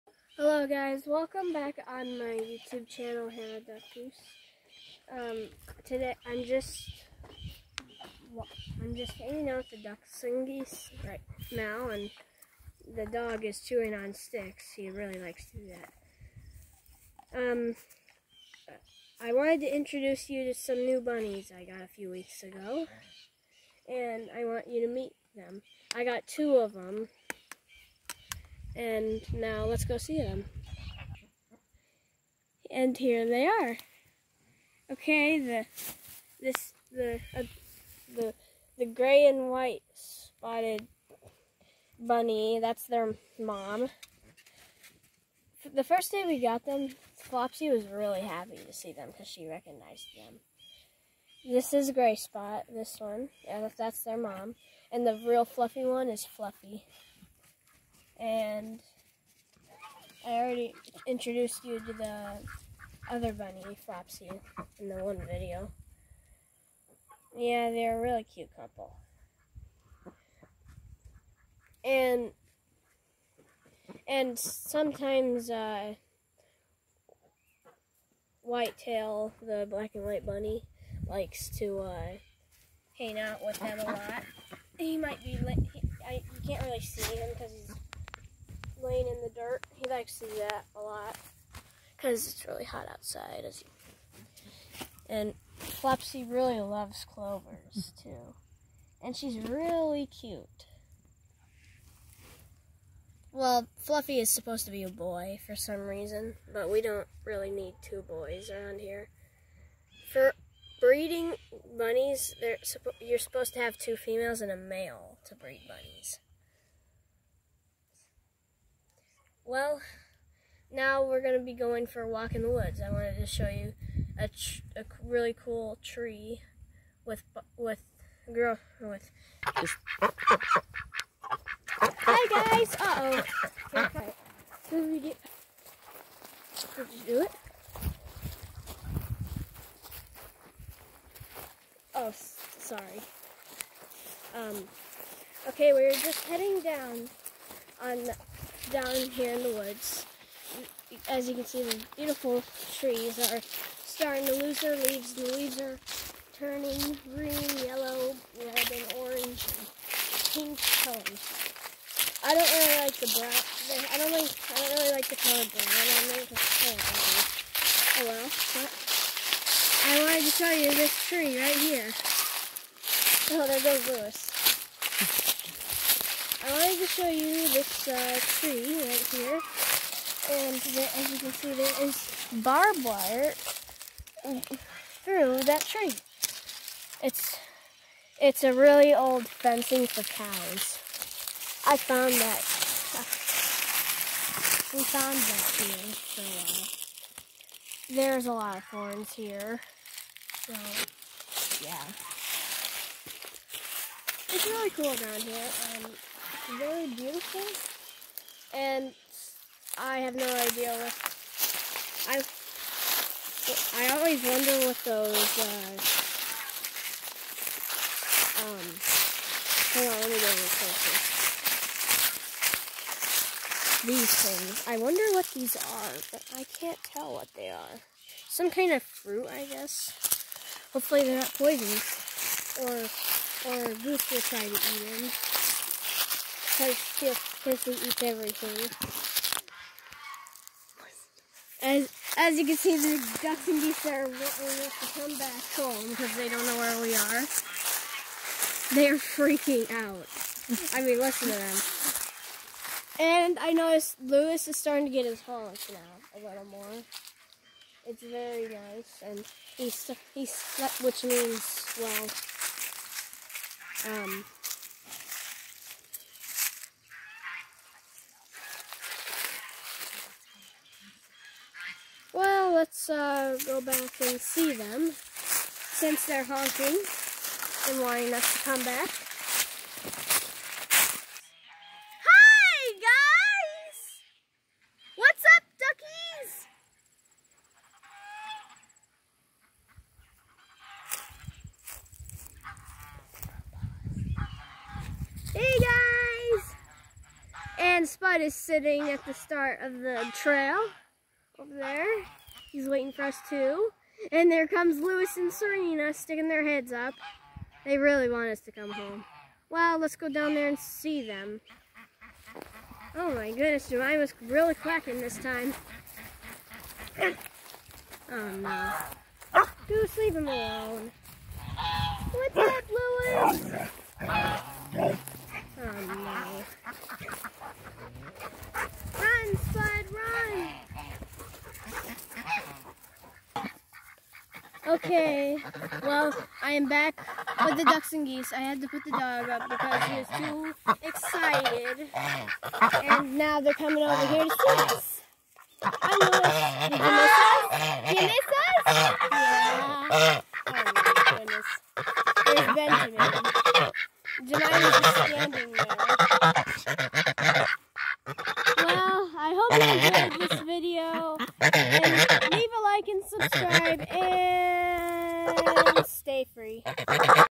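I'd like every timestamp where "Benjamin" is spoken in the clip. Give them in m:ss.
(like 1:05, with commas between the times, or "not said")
5:52.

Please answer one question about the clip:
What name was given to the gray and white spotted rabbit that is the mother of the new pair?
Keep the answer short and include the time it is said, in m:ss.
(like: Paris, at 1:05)
Gray Spot, at 0:51.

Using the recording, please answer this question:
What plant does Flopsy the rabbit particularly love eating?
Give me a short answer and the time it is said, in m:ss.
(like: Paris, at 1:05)
Clovers, at 1:37.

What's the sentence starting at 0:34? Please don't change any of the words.
Okay, the this the uh, the the gray and white spotted bunny, that's their mom.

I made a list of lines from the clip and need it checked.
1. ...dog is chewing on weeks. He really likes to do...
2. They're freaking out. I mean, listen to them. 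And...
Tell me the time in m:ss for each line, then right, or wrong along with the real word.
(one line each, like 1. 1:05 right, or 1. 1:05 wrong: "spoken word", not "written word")
1. 0:13 wrong: "sticks", not "weeks"
2. 4:08 right.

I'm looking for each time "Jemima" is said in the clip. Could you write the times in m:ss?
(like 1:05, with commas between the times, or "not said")
5:13, 5:54.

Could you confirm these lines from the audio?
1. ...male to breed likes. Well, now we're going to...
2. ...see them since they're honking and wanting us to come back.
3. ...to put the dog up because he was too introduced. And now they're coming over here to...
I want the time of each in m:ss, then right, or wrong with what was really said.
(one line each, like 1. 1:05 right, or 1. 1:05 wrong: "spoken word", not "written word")
1. 1:54 wrong: "bunnies", not "likes"
2. 4:34 right
3. 5:38 wrong: "excited", not "introduced".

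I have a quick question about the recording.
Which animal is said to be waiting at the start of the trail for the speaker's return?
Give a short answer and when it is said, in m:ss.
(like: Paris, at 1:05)
Spud, at 4:57.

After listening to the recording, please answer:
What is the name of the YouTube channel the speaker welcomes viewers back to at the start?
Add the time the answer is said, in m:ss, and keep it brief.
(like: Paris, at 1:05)
Hannah Duck Goose, at 0:03.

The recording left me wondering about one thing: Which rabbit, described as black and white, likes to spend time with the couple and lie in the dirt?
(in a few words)
Whitetail.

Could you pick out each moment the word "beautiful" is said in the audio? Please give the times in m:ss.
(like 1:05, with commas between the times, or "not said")
2:31, 3:26.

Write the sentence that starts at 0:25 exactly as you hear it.
I got two of them, and now let's go see them.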